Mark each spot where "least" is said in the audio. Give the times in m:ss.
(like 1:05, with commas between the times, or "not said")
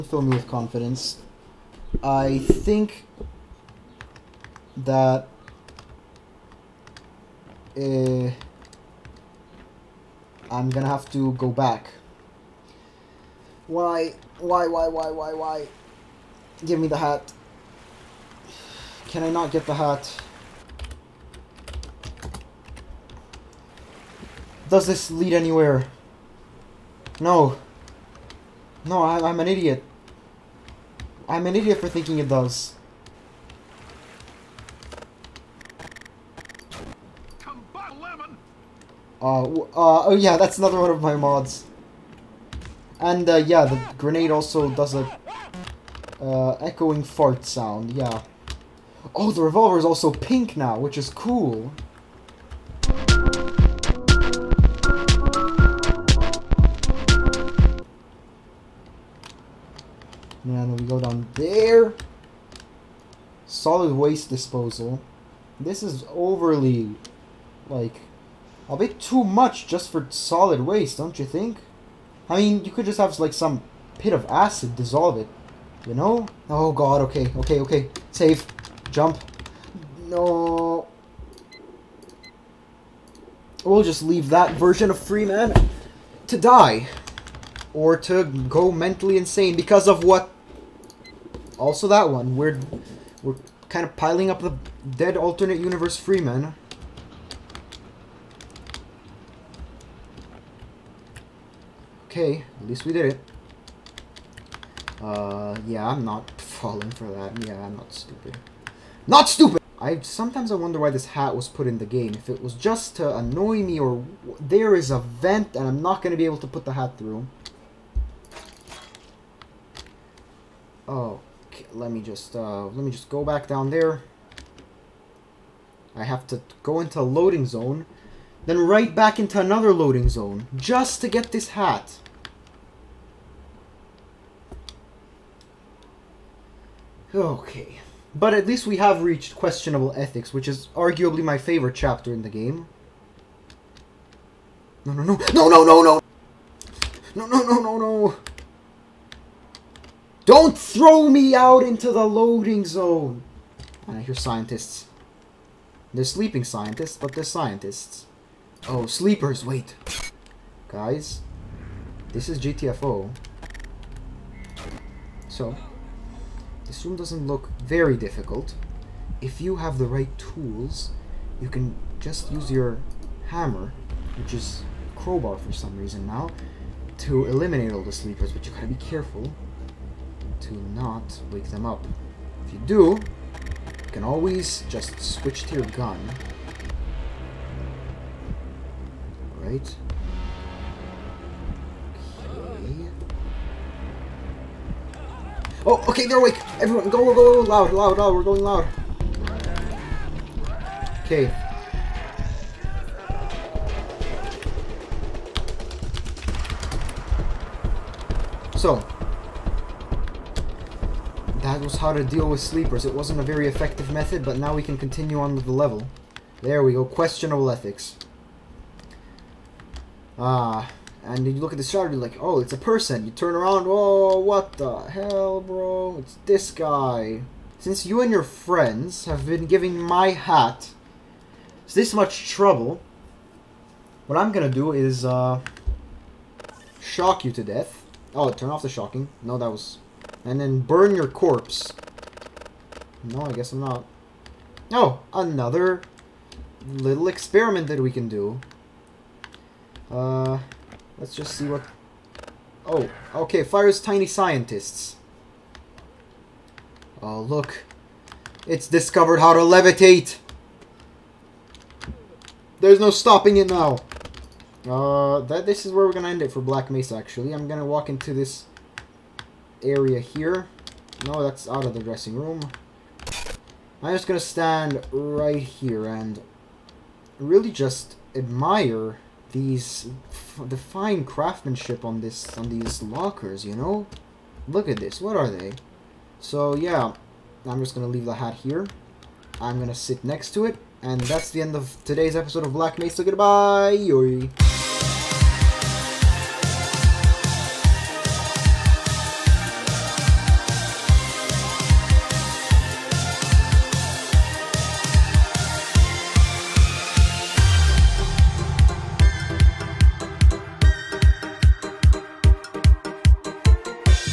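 1:42, 2:18.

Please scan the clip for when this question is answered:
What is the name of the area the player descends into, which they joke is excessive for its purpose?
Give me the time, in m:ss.
1:03.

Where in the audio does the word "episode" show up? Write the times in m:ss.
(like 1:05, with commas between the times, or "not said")
4:52.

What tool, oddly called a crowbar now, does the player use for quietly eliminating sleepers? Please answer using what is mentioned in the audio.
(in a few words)
Hammer.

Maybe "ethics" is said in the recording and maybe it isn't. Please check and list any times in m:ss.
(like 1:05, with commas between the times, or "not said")
2:19, 3:37.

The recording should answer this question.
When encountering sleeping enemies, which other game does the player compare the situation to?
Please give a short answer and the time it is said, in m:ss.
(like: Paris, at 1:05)
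GTFO, at 2:42.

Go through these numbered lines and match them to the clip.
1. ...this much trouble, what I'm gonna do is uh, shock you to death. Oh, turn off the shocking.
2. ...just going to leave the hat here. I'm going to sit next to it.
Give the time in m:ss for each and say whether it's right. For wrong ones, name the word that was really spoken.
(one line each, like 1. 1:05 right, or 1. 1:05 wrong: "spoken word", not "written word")
1. 3:51 right
2. 4:47 right.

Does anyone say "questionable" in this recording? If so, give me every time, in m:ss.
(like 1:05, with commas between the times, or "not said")
2:19, 3:36.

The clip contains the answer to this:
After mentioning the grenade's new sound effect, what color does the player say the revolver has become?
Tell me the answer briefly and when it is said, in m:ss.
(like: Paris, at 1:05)
Pink, at 0:50.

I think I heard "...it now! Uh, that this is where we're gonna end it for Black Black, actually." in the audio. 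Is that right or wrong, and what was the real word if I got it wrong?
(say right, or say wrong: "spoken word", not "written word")
wrong: "Mesa", not "Black".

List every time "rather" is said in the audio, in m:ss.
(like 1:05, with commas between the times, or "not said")
not said.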